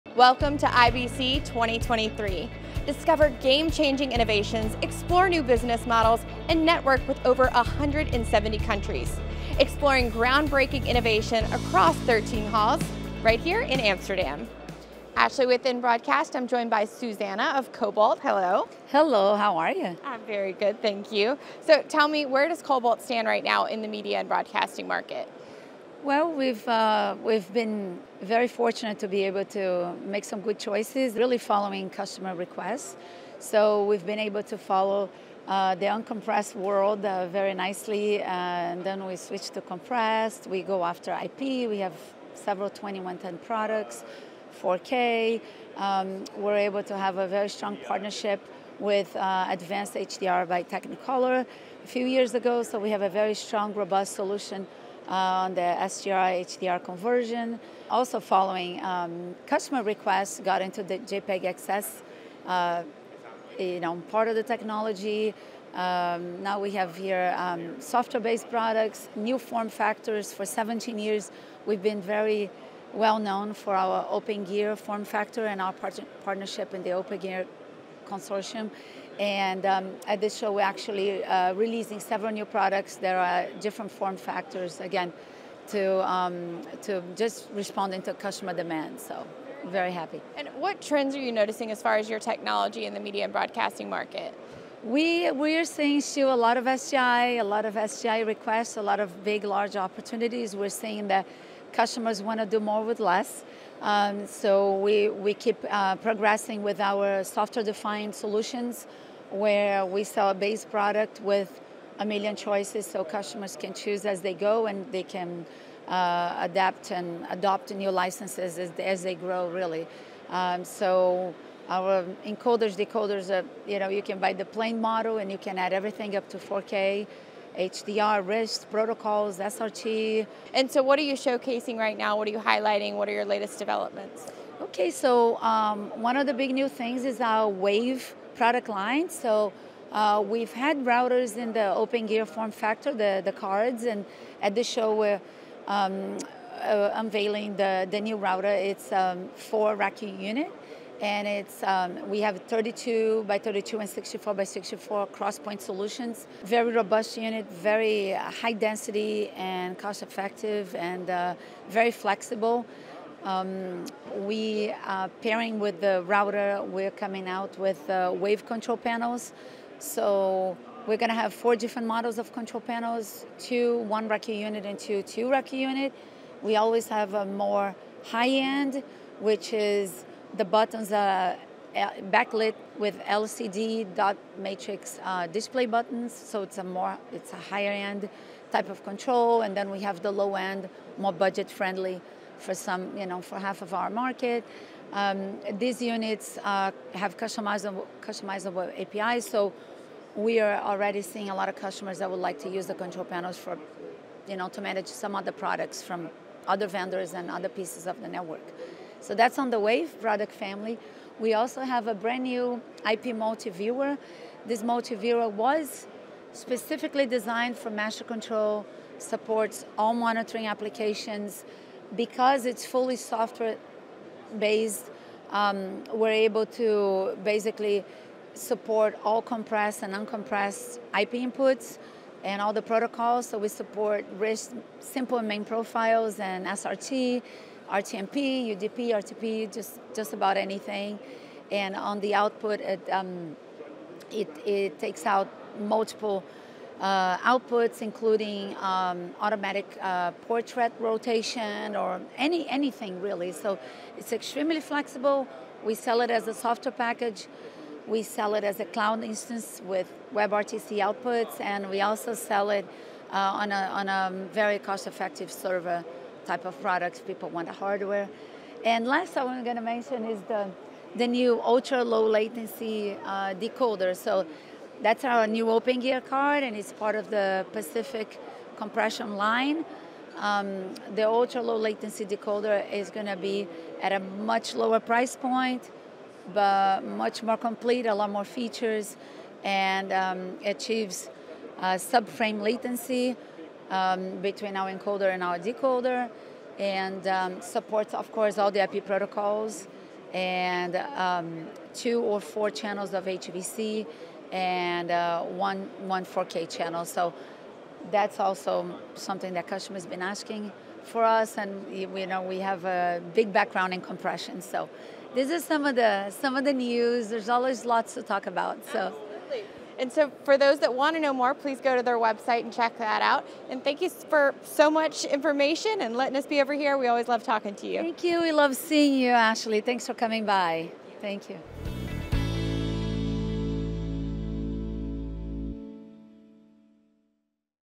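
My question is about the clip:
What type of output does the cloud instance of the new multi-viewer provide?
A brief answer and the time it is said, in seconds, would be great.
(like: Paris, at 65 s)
WebRTC, at 260 s.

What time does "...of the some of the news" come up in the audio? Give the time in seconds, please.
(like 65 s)
315 s.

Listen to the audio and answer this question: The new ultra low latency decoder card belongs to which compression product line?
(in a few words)
Pacific.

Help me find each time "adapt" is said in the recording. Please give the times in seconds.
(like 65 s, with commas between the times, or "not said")
116 s.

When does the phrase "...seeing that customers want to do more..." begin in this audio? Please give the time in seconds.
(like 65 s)
100 s.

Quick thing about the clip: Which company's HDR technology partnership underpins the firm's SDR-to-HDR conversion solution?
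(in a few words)
Technicolor.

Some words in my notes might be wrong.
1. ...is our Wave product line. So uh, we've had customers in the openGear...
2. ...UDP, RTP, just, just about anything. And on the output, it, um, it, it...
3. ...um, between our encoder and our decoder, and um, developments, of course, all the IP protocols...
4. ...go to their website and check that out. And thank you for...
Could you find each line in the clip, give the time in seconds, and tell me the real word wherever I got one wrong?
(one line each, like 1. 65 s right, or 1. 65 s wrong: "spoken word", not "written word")
1. 137 s wrong: "routers", not "customers"
2. 238 s right
3. 293 s wrong: "supports", not "developments"
4. 321 s right.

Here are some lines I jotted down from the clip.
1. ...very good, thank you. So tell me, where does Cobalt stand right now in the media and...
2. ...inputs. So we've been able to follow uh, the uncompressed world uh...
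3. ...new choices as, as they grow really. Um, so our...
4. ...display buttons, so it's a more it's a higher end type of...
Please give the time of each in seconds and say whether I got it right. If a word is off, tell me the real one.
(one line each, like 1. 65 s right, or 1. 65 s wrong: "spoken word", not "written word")
1. 20 s right
2. 32 s wrong: "requests", not "inputs"
3. 117 s wrong: "licenses", not "choices"
4. 185 s right.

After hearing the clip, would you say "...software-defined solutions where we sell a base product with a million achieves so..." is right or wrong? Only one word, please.
wrong.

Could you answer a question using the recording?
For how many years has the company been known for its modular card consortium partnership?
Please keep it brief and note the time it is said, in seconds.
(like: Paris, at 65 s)
17, at 70 s.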